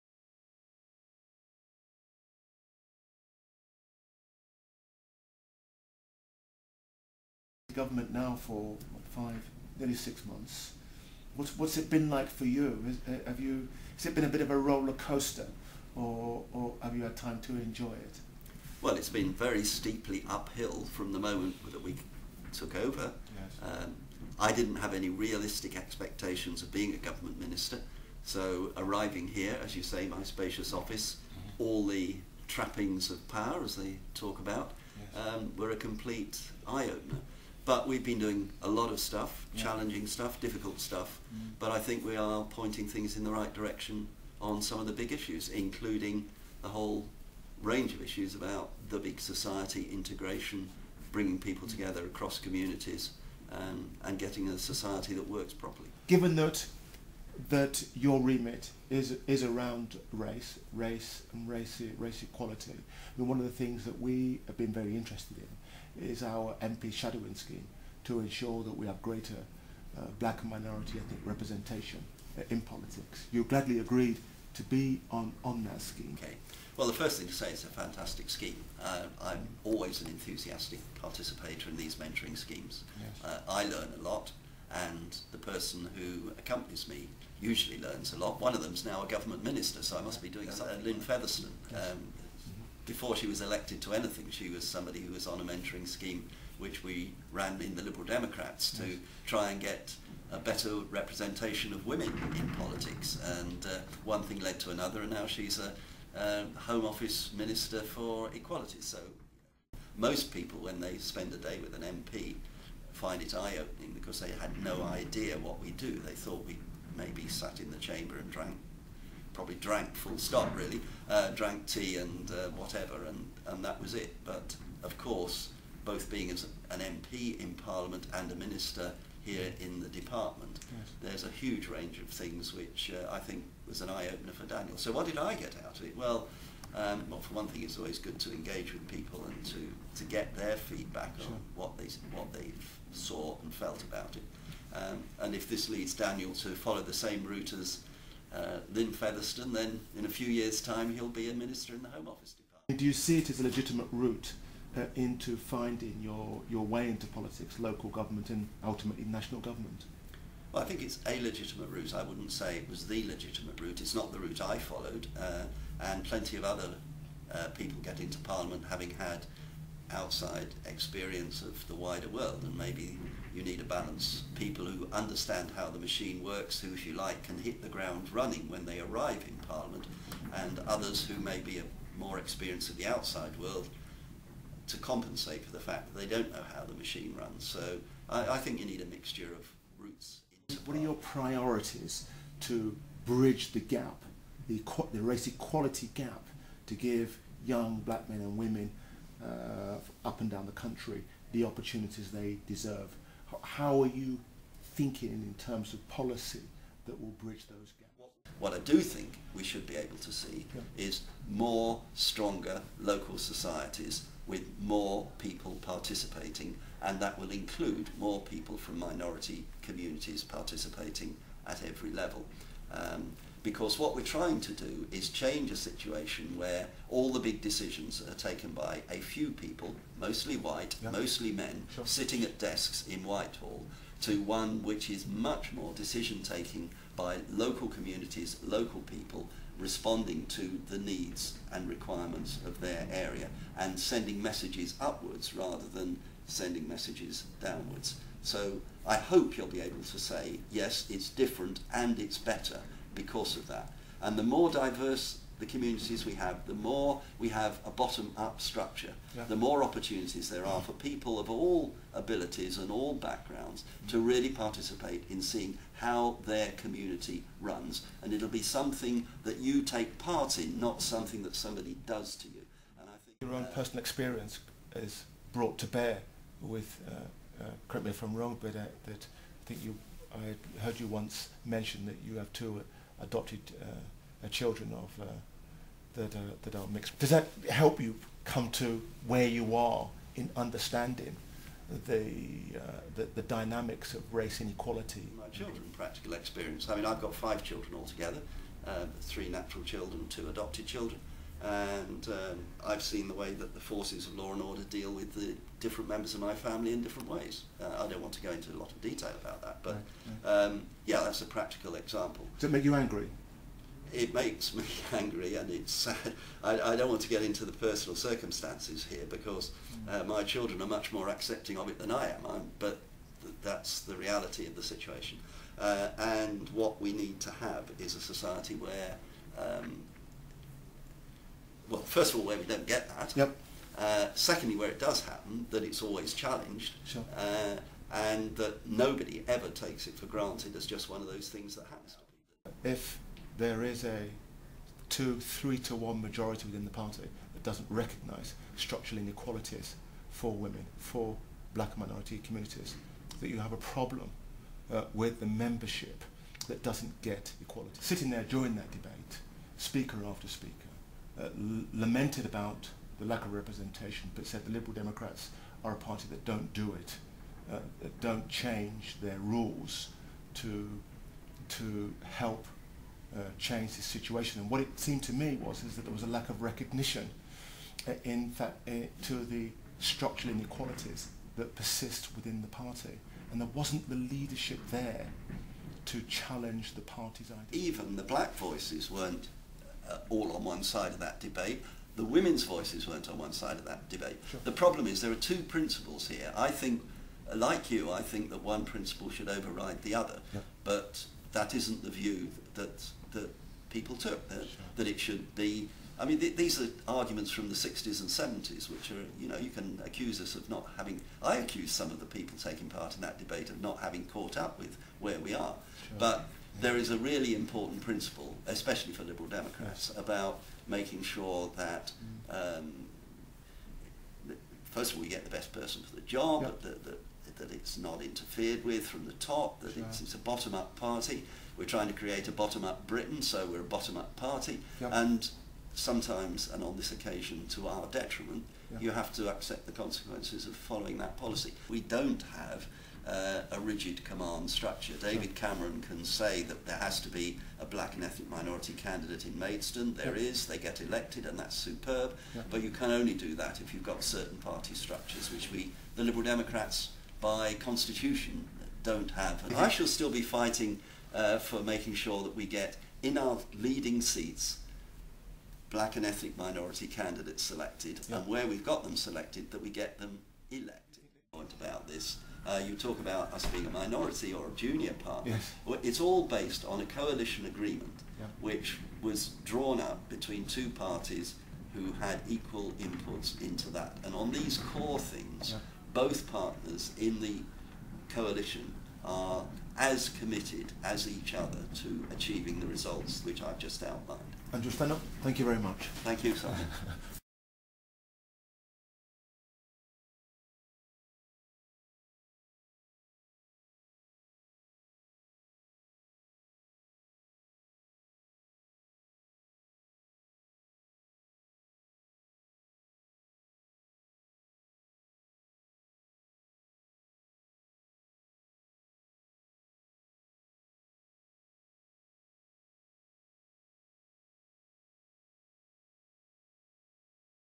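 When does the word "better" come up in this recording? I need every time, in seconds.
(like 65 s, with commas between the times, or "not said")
100 s, 252 s.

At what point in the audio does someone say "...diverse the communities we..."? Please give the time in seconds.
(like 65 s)
254 s.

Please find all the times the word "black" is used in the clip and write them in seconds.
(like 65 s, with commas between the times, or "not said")
70 s, 197 s, 351 s, 388 s, 447 s, 465 s.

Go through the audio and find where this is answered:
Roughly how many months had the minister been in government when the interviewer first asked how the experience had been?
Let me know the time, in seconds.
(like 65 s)
9 s.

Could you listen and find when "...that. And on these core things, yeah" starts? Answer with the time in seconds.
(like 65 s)
483 s.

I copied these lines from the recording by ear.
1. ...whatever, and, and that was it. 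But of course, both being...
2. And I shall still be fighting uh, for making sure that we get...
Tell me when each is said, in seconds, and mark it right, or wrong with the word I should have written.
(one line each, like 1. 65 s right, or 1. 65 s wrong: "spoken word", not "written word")
1. 122 s right
2. 459 s right.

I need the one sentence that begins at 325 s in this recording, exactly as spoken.
Uh, and what we need to have is a society where um, first of all, where we don't get that.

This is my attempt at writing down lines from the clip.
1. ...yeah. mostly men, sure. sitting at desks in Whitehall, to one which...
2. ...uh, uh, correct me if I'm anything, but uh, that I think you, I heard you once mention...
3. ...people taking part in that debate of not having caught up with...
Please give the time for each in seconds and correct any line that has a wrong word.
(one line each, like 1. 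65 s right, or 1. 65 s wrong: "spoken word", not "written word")
1. 230 s right
2. 276 s wrong: "wrong", not "anything"
3. 412 s right.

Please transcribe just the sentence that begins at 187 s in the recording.
So I, I think you need a mixture of routes.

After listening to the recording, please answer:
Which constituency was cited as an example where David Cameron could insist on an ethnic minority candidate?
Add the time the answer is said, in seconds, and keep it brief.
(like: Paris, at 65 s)
Maidstone, at 449 s.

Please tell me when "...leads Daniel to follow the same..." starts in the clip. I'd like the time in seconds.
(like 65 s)
145 s.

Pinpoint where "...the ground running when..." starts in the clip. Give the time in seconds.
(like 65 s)
177 s.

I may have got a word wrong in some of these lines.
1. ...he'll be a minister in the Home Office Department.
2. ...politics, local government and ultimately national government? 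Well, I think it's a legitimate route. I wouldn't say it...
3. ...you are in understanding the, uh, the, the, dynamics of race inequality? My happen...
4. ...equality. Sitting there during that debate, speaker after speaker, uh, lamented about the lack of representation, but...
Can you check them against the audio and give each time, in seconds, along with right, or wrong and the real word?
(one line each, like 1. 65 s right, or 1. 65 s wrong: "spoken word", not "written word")
1. 150 s right
2. 157 s right
3. 289 s wrong: "children", not "happen"
4. 357 s right.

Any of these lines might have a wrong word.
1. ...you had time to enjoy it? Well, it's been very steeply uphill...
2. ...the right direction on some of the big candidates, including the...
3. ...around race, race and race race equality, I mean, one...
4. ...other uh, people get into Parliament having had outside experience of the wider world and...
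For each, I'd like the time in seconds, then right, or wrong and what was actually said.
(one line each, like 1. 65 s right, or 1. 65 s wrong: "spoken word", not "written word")
1. 16 s right
2. 43 s wrong: "issues", not "candidates"
3. 59 s right
4. 166 s right.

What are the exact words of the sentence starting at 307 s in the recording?
Uh, I don't want to go into a lot of detail about that, but um, yeah, that's a practical example.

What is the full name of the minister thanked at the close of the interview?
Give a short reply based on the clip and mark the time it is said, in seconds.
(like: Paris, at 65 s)
Andrew Stunell, at 494 s.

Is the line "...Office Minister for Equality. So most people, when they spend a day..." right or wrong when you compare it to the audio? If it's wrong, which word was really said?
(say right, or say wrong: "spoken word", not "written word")
right.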